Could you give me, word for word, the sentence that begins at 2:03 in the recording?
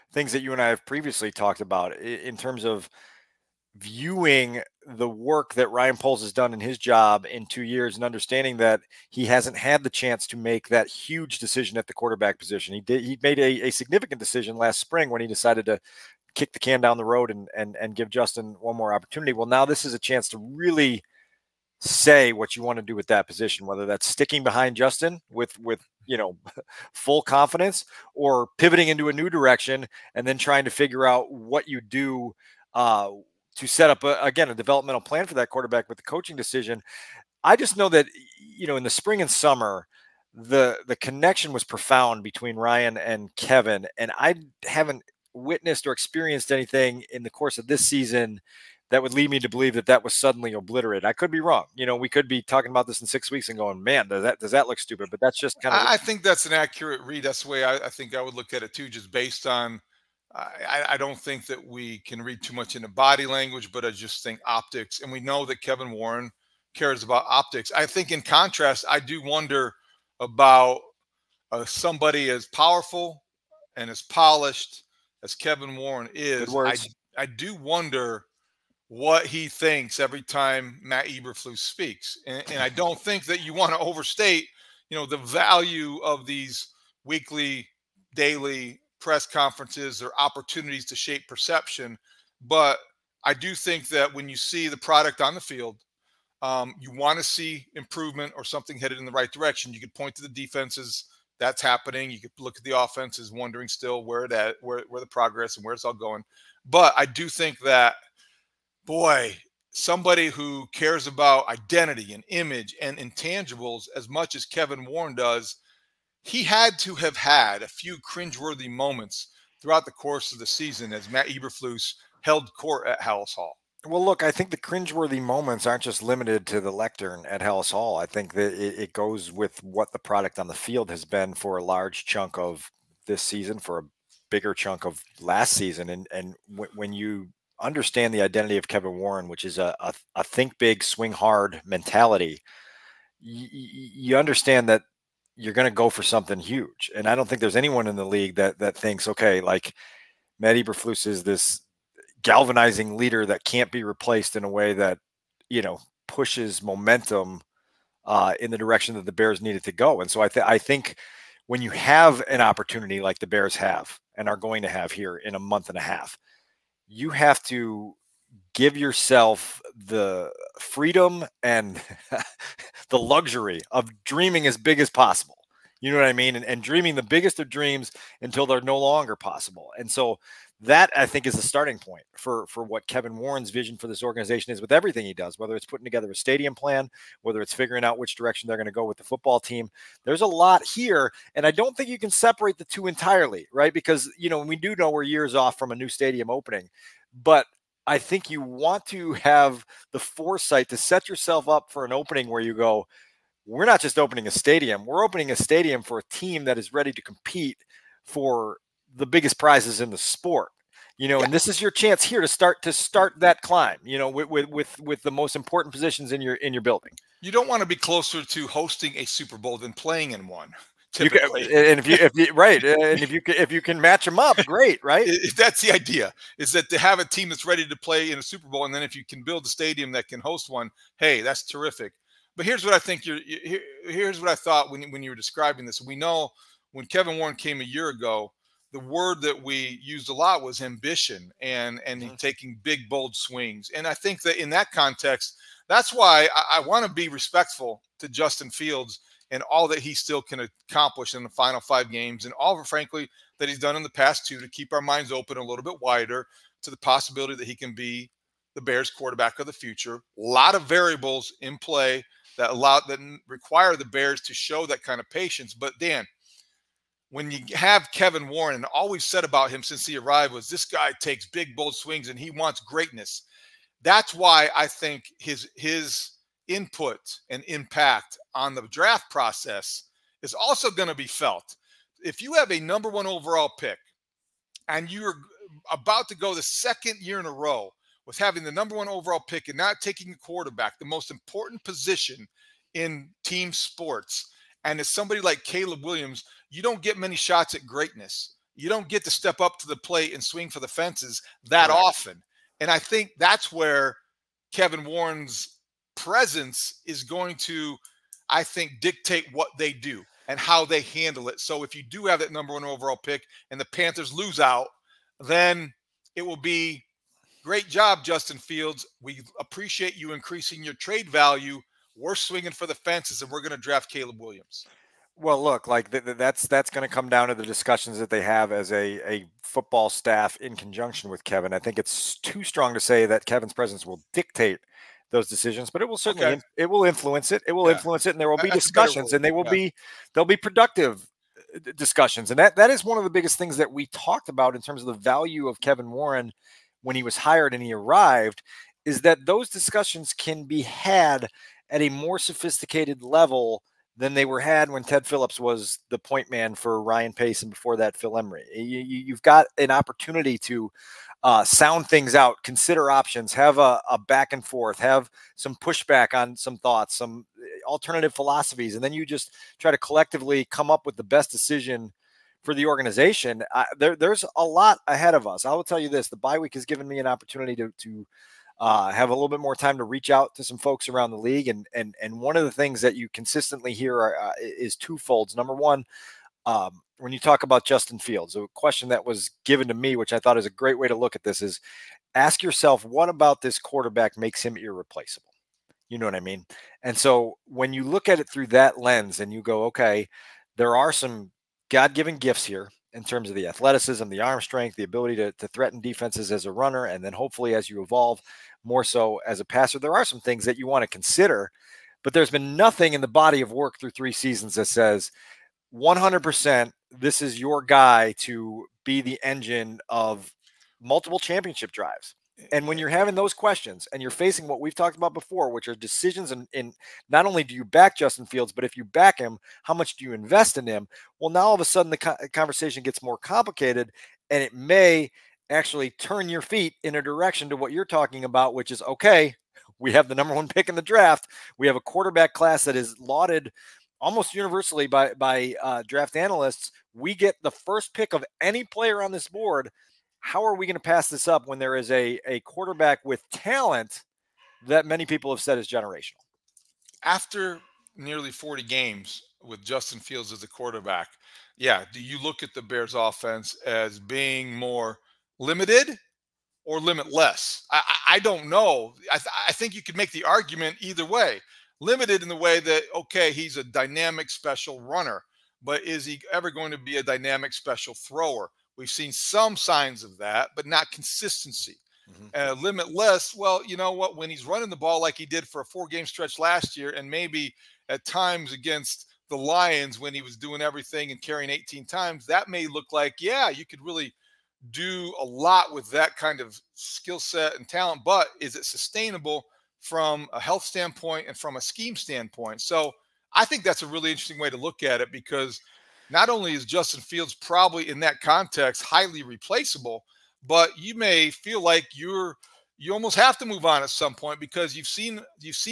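Well, look, I think the cringeworthy moments aren't just limited to the lectern at Halas Hall.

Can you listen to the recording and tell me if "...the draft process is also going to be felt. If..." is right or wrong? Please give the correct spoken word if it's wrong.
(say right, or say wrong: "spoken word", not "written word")
right.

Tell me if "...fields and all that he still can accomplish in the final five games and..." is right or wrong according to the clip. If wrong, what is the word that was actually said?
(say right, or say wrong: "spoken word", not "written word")
right.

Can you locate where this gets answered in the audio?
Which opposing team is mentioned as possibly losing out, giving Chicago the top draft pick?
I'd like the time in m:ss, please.
5:13.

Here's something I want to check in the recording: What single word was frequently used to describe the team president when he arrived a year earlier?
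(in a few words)
ambition.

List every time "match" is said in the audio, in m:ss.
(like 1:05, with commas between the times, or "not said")
3:43.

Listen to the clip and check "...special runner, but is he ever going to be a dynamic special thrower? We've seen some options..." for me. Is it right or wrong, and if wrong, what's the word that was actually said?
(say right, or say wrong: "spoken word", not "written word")
wrong: "signs", not "options".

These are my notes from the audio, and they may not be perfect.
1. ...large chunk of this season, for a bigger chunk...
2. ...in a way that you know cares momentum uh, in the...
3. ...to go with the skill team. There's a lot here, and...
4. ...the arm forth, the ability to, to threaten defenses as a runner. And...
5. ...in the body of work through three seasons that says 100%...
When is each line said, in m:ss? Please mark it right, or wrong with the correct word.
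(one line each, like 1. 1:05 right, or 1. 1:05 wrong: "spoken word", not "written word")
1. 2:11 right
2. 2:34 wrong: "pushes", not "cares"
3. 3:08 wrong: "football", not "skill"
4. 6:44 wrong: "strength", not "forth"
5. 6:52 right.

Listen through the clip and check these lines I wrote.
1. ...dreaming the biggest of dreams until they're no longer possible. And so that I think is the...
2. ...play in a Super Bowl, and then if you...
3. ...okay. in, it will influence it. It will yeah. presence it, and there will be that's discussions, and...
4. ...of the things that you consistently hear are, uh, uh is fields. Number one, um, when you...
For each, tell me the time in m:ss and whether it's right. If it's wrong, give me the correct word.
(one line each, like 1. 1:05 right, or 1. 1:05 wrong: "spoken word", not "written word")
1. 2:56 right
2. 3:47 right
3. 5:36 wrong: "influence", not "presence"
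4. 6:22 wrong: "twofolds", not "fields".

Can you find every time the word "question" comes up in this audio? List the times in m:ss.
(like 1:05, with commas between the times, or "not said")
6:28, 7:03.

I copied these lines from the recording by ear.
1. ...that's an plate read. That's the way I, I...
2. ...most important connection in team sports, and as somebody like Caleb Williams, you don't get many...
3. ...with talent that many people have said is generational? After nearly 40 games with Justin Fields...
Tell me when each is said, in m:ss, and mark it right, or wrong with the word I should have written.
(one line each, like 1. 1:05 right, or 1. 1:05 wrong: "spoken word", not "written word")
1. 0:56 wrong: "accurate", not "plate"
2. 4:50 wrong: "position", not "connection"
3. 7:33 right.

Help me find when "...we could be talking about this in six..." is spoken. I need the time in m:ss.
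0:51.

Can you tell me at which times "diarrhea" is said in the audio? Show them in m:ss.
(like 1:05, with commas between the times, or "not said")
not said.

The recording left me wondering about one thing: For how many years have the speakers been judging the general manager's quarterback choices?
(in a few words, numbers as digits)
2.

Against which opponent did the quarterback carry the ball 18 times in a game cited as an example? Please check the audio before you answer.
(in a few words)
Lions.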